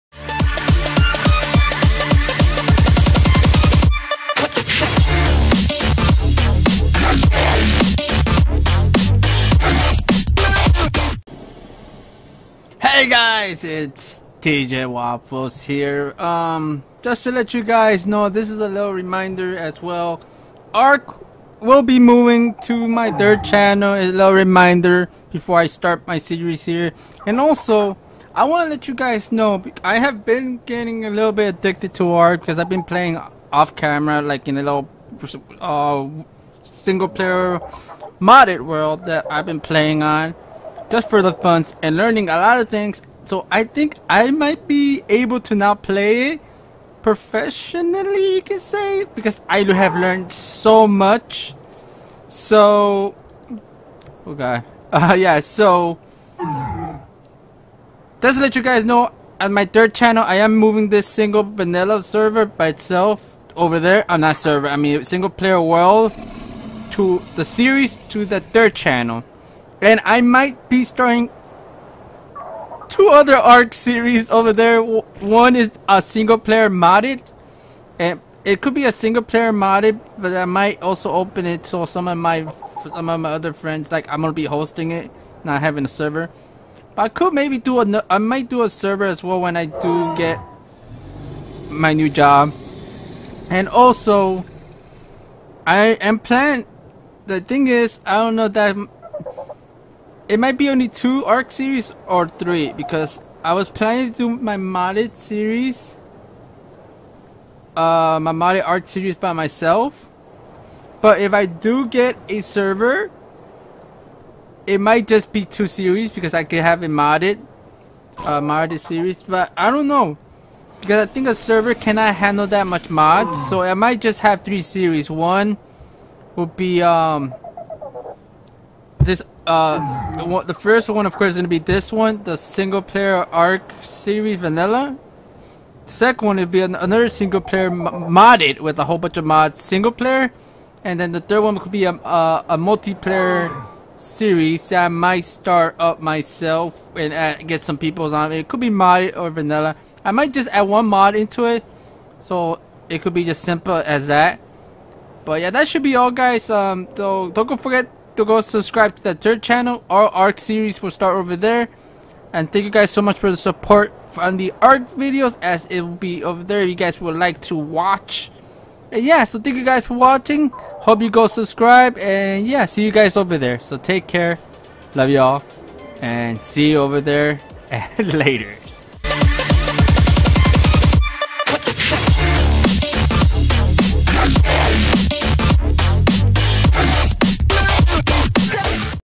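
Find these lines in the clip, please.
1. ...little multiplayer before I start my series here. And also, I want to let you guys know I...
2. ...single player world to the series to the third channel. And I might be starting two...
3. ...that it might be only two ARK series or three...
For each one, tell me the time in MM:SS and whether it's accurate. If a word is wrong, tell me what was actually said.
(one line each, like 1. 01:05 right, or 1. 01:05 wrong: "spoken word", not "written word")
1. 00:24 wrong: "reminder", not "multiplayer"
2. 01:05 right
3. 01:38 right.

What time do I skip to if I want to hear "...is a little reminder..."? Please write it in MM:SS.
00:18.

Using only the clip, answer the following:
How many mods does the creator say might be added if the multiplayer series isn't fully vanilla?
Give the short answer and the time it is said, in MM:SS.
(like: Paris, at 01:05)
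1, at 02:30.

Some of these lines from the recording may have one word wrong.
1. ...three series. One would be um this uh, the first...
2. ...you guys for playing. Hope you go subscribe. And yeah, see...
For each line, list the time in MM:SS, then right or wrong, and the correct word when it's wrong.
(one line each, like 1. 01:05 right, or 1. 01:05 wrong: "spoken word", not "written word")
1. 02:04 right
2. 02:49 wrong: "watching", not "playing".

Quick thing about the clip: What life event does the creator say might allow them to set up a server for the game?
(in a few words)
new job.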